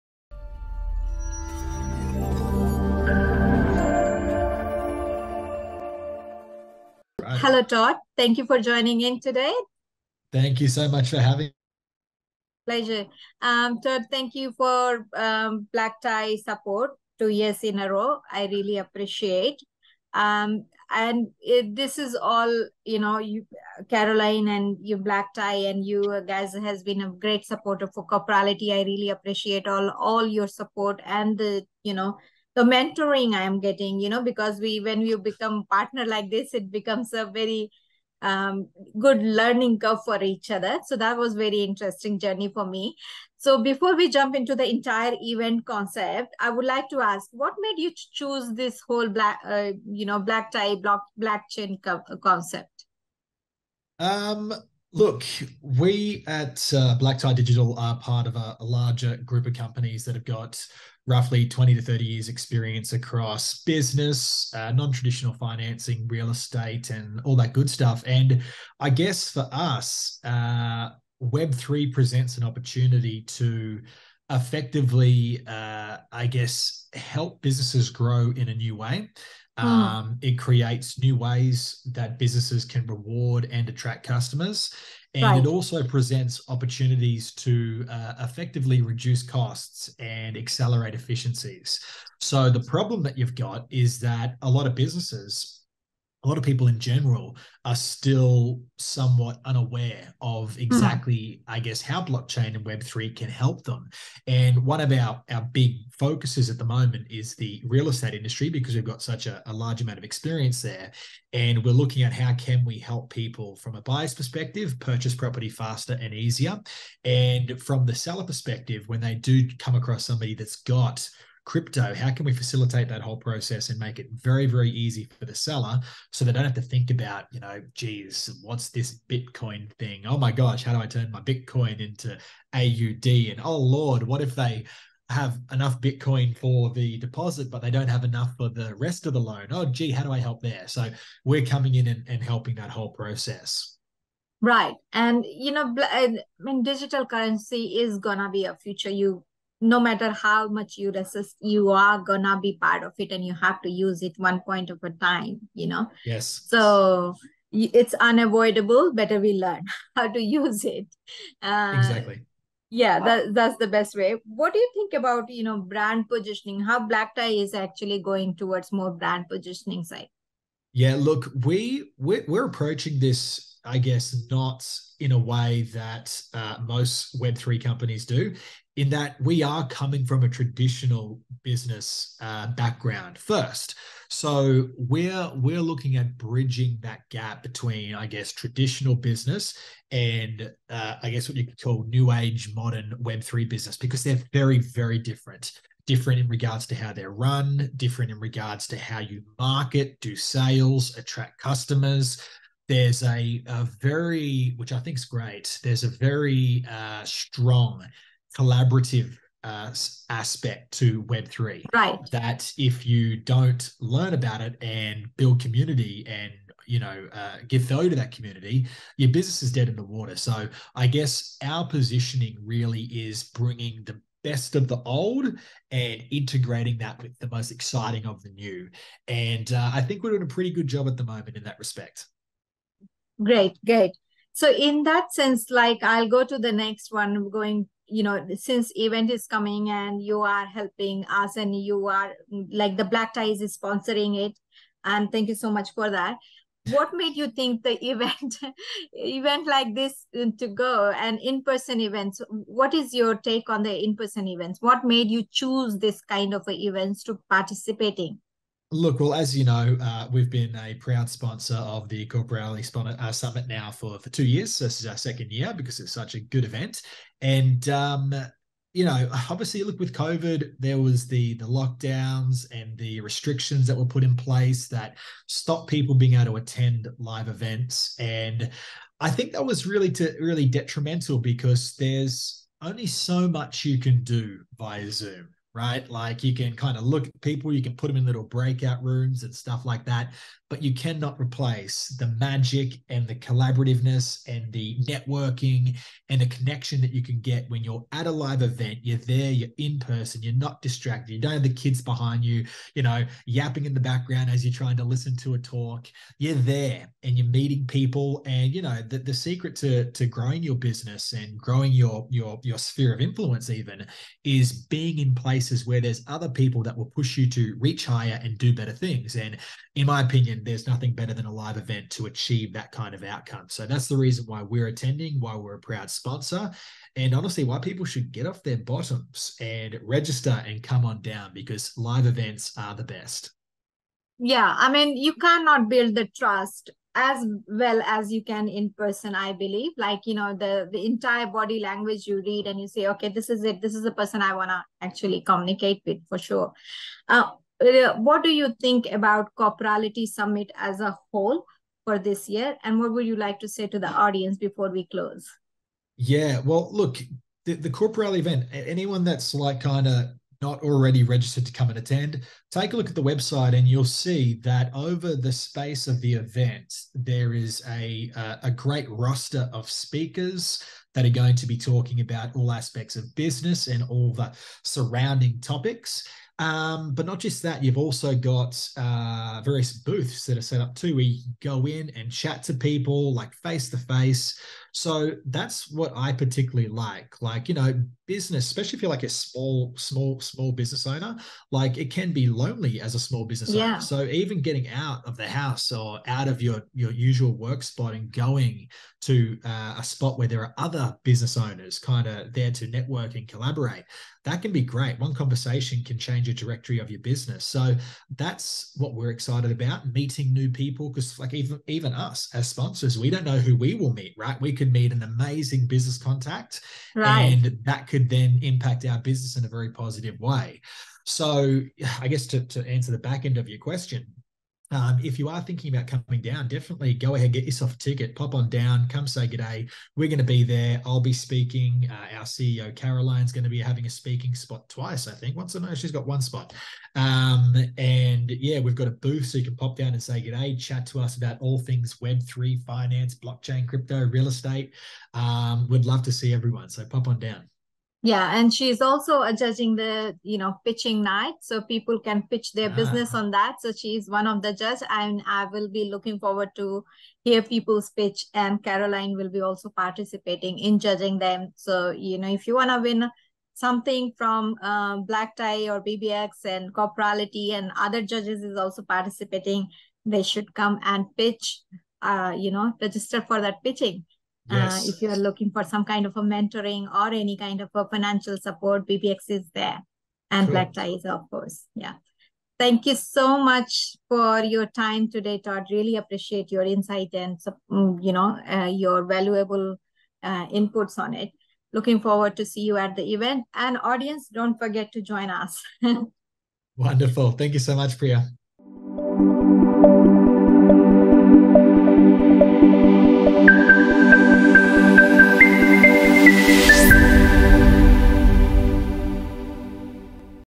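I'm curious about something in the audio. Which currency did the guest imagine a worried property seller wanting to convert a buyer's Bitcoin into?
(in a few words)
AUD.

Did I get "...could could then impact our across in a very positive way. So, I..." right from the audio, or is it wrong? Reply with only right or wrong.
wrong.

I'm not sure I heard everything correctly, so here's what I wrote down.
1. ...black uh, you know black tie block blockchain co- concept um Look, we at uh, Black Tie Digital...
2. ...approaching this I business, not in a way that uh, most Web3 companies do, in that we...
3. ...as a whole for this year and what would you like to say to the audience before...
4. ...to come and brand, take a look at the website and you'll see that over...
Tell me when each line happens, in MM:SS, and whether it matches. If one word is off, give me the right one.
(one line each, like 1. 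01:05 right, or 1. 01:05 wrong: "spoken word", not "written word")
1. 00:49 right
2. 02:52 wrong: "guess", not "business"
3. 05:50 right
4. 06:01 wrong: "attend", not "brand".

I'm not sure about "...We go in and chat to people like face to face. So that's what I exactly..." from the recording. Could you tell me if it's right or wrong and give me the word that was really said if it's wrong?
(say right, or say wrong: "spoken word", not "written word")
wrong: "particularly", not "exactly".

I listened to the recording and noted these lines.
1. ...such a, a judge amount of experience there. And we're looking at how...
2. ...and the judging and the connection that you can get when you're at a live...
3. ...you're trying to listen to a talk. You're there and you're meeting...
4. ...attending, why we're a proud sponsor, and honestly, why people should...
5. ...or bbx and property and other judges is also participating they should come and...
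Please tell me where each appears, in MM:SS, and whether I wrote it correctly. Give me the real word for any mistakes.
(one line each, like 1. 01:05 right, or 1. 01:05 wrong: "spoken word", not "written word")
1. 01:49 wrong: "large", not "judge"
2. 04:54 wrong: "networking", not "judging"
3. 05:04 right
4. 05:24 right
5. 07:45 wrong: "corporality", not "property".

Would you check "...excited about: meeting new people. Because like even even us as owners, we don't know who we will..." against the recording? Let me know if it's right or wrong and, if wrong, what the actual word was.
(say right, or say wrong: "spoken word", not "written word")
wrong: "sponsors", not "owners".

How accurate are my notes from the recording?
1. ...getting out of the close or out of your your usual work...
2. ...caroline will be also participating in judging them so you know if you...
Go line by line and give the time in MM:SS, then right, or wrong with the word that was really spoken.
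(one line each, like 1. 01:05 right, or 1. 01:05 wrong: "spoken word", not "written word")
1. 06:34 wrong: "house", not "close"
2. 07:38 right.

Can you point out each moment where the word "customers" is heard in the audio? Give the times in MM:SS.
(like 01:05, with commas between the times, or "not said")
01:24, 03:21.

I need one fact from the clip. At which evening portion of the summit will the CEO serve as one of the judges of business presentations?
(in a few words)
Pitching night.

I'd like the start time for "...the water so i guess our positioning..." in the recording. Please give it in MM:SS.
03:39.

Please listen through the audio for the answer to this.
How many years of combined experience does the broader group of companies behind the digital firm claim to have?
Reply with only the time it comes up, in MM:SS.
01:01.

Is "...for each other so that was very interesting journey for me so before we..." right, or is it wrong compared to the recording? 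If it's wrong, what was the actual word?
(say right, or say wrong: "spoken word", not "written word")
right.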